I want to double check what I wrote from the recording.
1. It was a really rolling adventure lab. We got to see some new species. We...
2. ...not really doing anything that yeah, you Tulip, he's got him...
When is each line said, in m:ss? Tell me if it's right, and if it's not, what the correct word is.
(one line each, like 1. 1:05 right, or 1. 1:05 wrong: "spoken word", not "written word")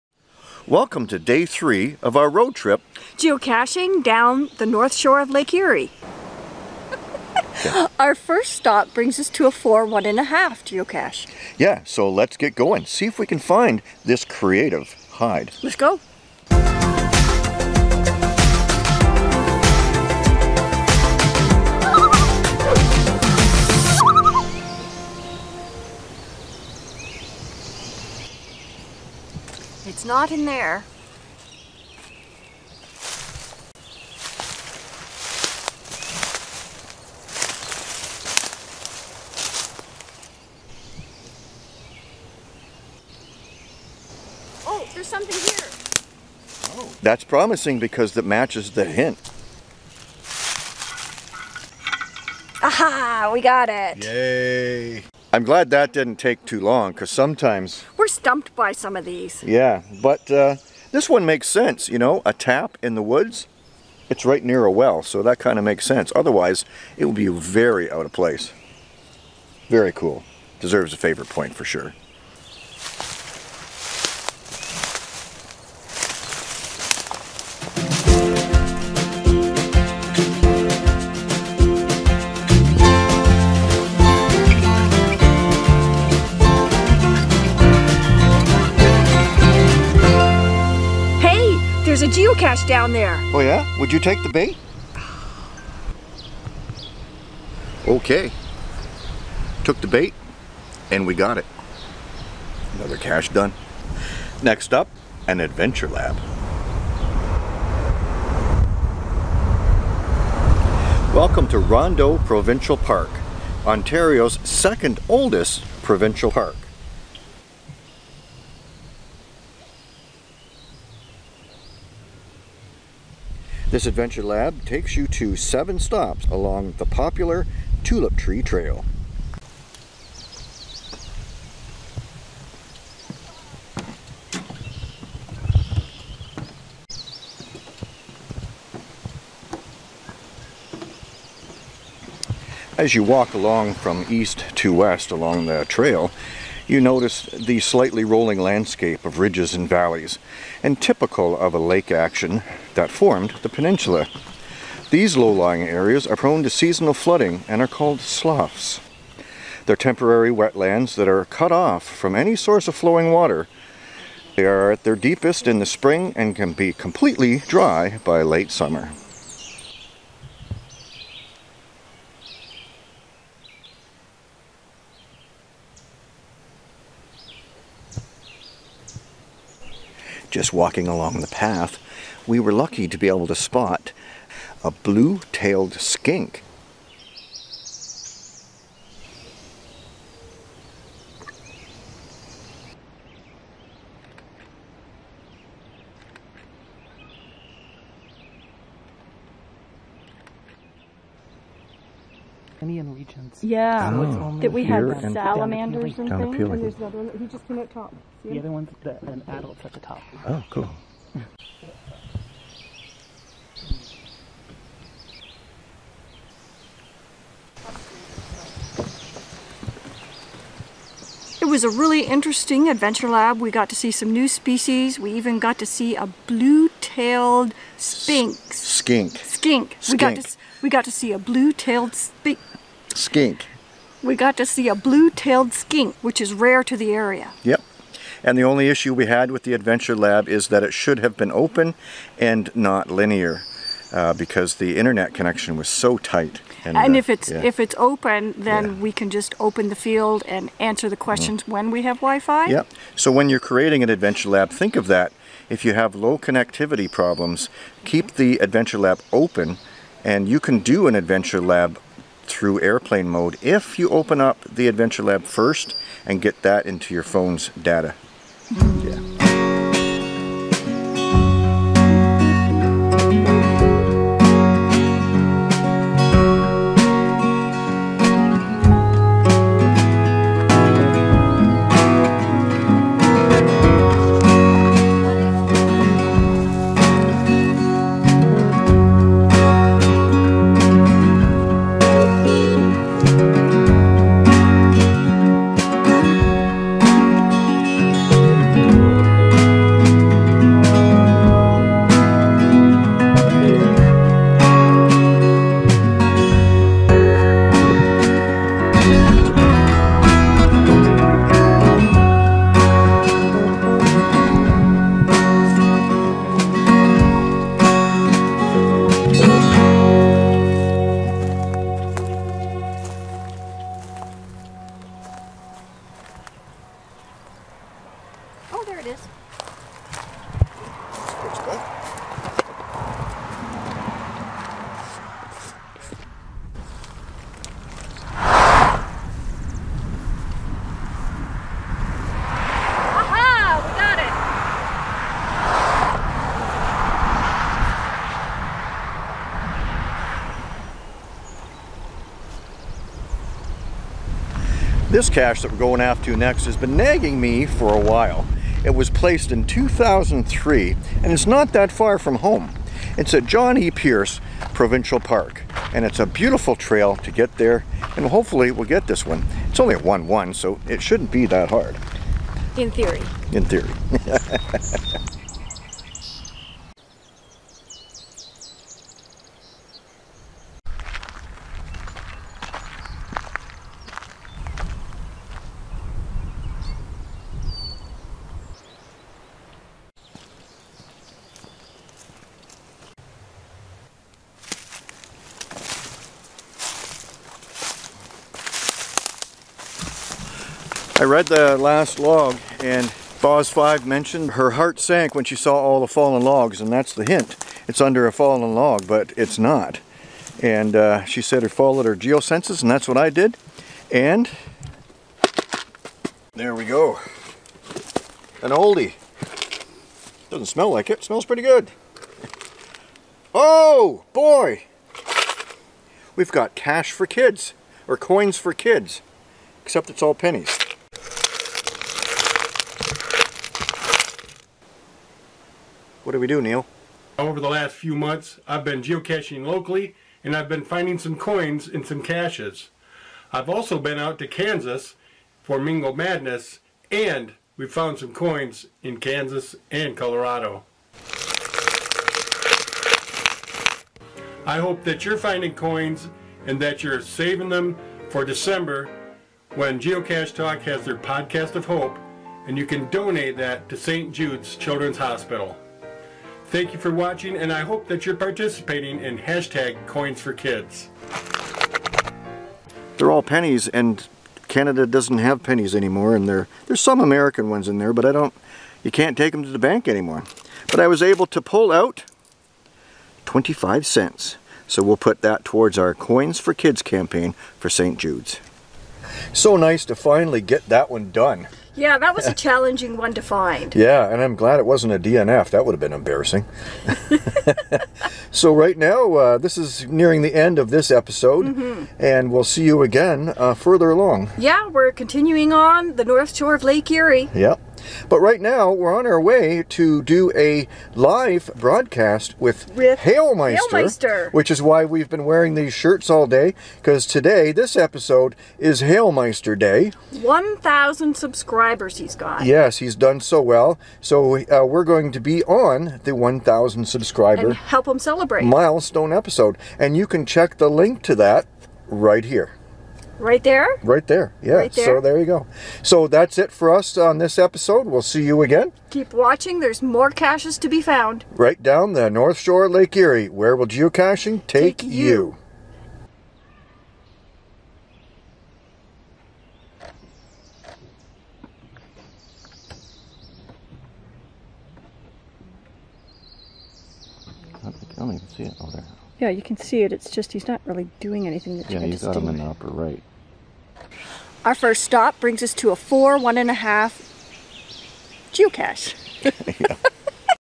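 1. 3:41 wrong: "interesting", not "rolling"
2. 9:20 wrong: "Yeah", not "Tulip".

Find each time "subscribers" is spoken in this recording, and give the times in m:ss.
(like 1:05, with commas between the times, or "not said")
8:41, 8:46.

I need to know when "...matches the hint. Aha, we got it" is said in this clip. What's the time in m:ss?
0:48.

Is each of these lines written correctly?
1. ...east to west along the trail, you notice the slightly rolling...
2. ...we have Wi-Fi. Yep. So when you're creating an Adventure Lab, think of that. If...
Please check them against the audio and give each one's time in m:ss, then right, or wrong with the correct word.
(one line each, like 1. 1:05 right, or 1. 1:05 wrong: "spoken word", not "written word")
1. 2:24 right
2. 4:11 right.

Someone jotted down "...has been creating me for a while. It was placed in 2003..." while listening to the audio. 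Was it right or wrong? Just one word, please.
wrong.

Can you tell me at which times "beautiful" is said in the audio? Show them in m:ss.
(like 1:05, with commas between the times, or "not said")
6:06.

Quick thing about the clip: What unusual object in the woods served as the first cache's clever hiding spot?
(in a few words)
a tap.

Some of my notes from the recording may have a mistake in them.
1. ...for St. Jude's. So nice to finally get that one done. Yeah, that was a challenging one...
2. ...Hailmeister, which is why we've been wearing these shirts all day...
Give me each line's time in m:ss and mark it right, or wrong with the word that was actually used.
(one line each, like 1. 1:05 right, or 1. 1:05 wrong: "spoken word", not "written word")
1. 8:07 right
2. 8:33 right.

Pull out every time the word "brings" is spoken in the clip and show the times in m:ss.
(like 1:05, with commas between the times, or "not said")
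0:08, 9:25.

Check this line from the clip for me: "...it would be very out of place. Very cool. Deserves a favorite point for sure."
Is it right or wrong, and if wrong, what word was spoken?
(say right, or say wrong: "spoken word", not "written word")
right.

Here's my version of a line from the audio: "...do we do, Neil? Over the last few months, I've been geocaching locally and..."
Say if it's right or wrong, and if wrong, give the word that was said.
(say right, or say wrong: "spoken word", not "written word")
right.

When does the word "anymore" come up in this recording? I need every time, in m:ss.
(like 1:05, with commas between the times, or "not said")
7:55, 7:59.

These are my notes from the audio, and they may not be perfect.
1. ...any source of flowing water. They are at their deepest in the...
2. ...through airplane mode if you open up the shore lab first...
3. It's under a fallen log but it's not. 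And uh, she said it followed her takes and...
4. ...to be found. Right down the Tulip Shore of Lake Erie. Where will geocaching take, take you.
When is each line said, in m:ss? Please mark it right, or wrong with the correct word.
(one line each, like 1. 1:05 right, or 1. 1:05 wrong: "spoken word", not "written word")
1. 2:42 right
2. 4:22 wrong: "adventure", not "shore"
3. 6:47 wrong: "geosenses", not "takes"
4. 9:00 wrong: "North", not "Tulip".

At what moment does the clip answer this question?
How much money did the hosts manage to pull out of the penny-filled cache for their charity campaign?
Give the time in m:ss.
8:03.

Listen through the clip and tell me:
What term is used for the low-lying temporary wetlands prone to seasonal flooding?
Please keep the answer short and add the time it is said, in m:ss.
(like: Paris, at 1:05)
sloughs, at 2:37.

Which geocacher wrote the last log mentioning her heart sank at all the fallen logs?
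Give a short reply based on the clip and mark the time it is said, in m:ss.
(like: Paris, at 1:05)
Boz 5, at 6:43.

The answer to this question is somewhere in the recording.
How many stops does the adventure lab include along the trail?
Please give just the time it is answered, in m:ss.
2:05.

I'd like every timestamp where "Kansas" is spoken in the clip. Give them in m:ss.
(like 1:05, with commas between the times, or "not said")
7:24, 7:28.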